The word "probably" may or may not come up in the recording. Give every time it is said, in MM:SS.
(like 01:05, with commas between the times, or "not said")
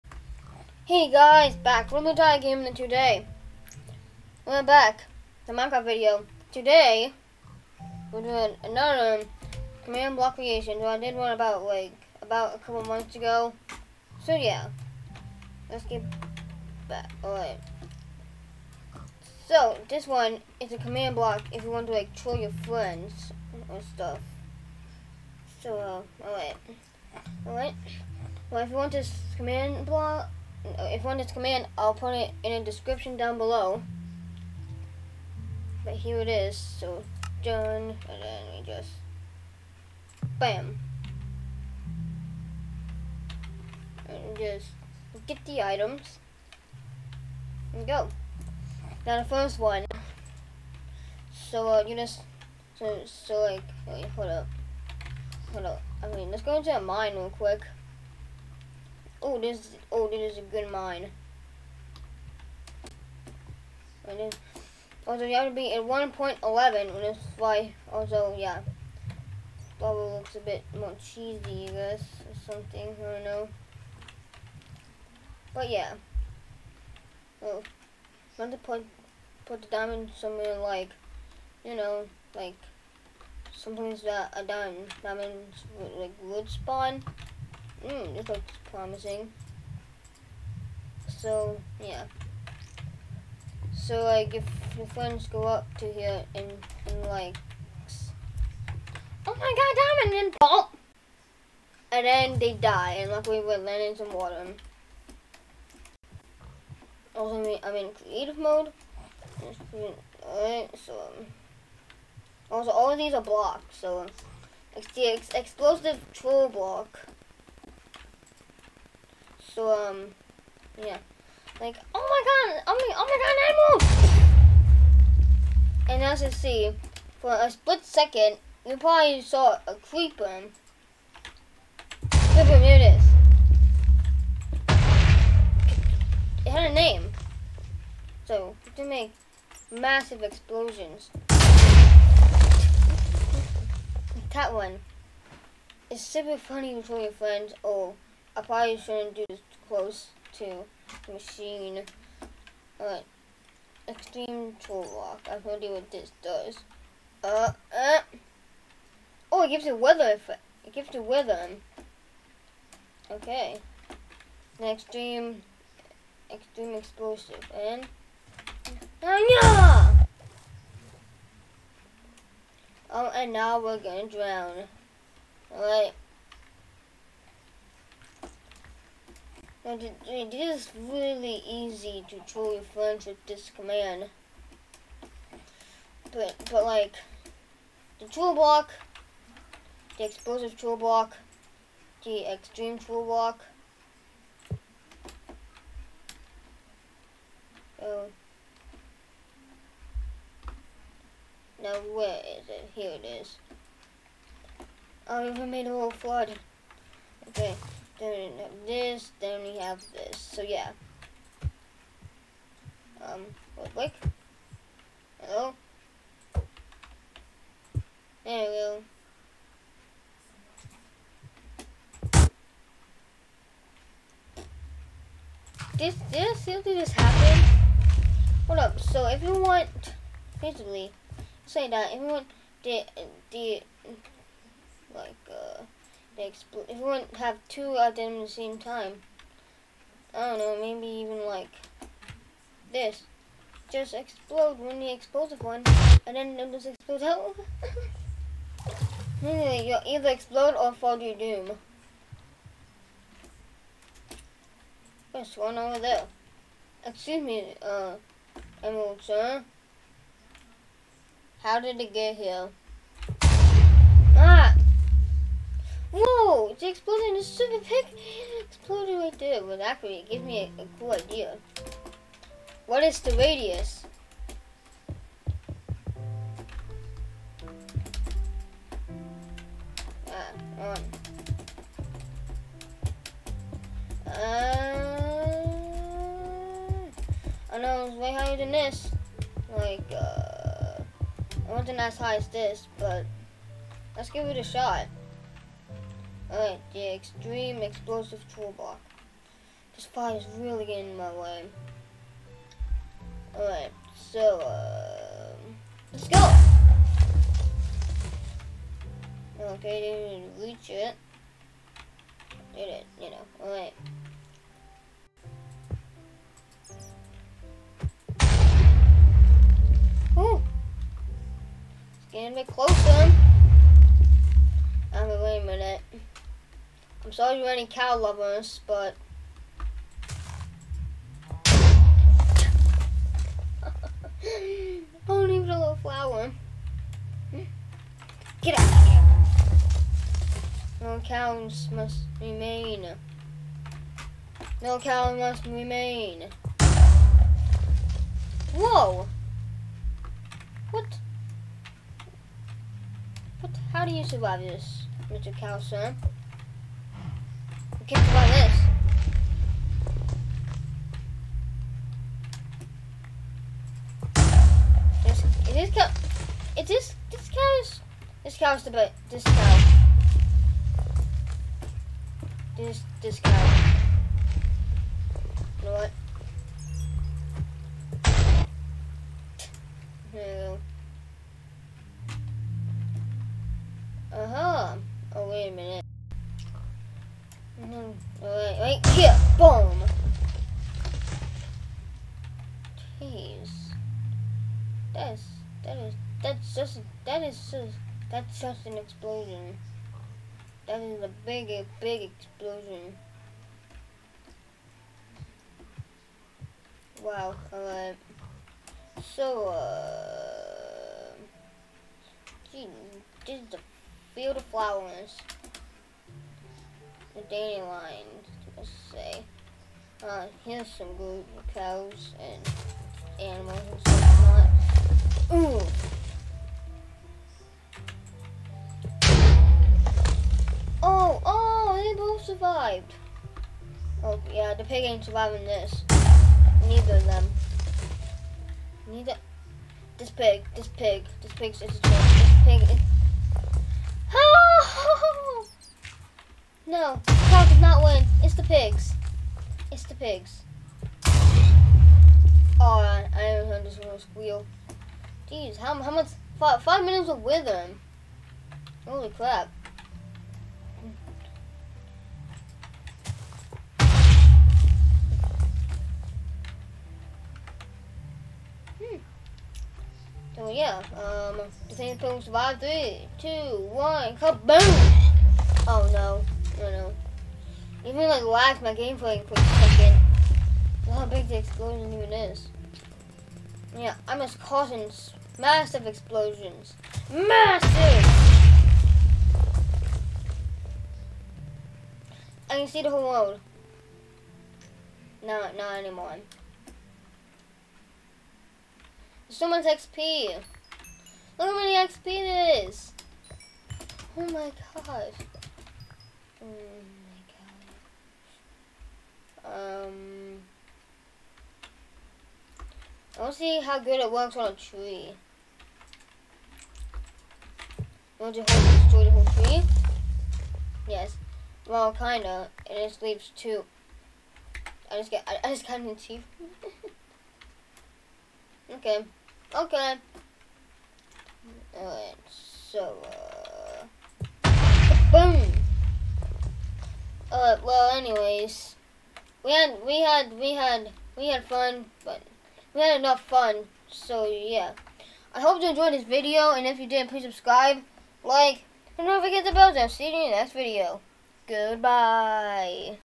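02:08, 02:28.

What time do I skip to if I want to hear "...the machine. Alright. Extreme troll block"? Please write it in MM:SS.
02:31.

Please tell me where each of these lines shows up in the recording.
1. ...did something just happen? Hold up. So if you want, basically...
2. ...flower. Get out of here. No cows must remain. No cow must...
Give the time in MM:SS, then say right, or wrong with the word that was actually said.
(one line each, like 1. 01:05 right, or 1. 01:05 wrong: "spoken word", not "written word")
1. 03:46 right
2. 05:35 right.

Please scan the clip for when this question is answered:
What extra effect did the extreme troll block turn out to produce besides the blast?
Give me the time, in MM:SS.
02:39.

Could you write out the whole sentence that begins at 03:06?
But, but like, the troll block, the explosive troll block, the extreme troll block, Oh.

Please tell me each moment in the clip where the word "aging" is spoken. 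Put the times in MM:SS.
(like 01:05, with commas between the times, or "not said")
not said.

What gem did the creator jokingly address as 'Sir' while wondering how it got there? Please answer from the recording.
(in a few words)
Emerald.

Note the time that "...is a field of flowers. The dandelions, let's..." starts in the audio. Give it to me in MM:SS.
06:53.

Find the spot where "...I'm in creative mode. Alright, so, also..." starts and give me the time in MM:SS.
01:47.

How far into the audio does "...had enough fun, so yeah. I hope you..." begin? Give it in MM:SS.
09:02.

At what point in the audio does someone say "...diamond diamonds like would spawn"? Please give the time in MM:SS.
01:24.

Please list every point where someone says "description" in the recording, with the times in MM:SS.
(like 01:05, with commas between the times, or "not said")
00:32.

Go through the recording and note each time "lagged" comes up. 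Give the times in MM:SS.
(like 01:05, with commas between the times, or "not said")
07:58.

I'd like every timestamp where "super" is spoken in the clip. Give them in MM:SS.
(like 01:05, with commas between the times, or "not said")
02:25, 04:27.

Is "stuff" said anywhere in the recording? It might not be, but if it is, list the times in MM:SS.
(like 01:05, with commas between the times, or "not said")
00:23, 07:03.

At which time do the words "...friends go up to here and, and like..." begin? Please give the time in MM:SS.
01:34.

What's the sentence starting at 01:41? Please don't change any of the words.
And then they die, and luckily we're landing some water.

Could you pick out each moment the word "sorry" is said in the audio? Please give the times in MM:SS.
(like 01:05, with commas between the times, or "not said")
05:27.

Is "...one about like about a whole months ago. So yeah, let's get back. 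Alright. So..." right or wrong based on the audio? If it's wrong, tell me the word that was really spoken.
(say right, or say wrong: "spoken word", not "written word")
wrong: "couple", not "whole".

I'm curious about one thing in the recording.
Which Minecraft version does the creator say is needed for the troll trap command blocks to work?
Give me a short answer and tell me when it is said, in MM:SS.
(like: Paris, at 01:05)
1.11, at 01:05.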